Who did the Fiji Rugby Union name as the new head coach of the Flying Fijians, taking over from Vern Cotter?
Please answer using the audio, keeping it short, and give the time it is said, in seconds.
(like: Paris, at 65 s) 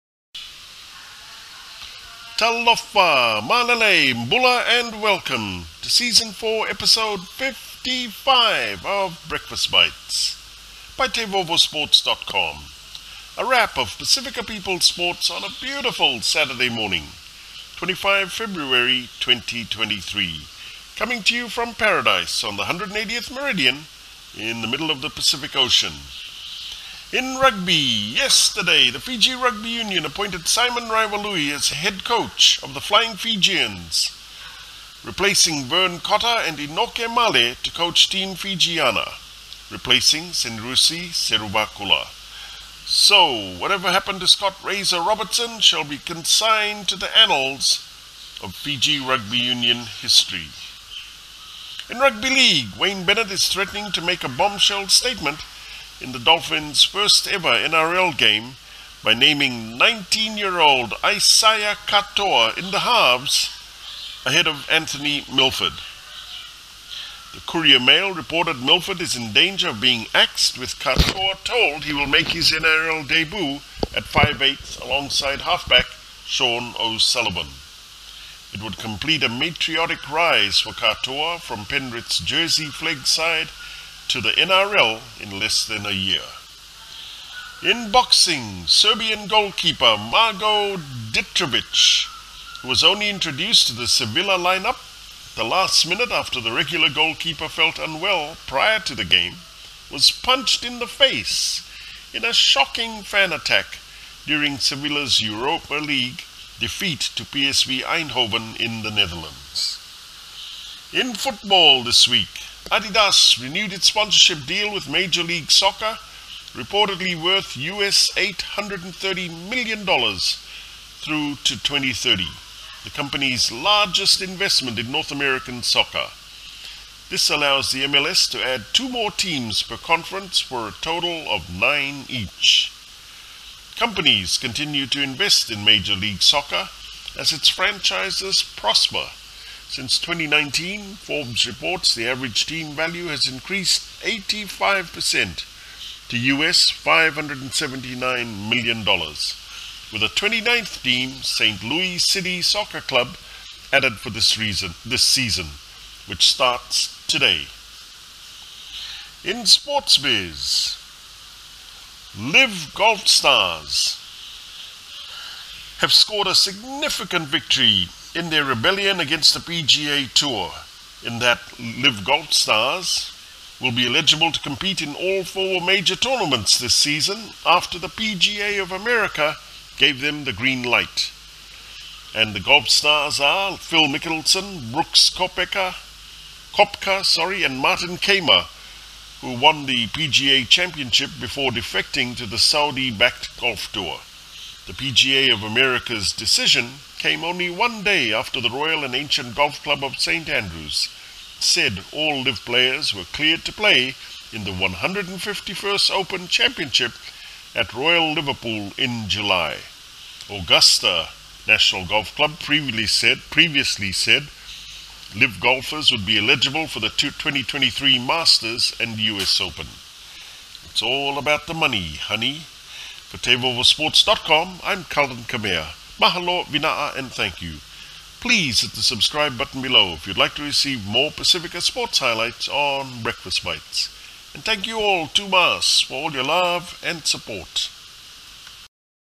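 Simon Raiwalui, at 30 s.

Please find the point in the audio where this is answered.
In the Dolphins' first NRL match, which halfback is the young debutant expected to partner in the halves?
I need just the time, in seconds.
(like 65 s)
76 s.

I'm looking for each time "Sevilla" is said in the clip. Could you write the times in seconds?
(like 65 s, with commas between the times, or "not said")
93 s, 104 s.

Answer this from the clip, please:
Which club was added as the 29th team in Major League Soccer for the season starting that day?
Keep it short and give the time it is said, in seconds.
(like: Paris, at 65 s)
St. Louis City Soccer Club, at 151 s.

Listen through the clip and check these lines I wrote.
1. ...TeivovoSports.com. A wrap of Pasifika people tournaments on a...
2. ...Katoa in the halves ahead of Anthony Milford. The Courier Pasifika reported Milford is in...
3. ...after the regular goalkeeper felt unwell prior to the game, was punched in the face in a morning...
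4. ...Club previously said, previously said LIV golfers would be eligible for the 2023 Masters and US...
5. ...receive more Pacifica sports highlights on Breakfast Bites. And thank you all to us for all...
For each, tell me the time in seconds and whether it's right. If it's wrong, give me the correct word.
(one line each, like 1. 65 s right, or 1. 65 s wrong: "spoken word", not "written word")
1. 11 s wrong: "sports", not "tournaments"
2. 61 s wrong: "Mail", not "Pasifika"
3. 96 s wrong: "shocking", not "morning"
4. 212 s right
5. 230 s right.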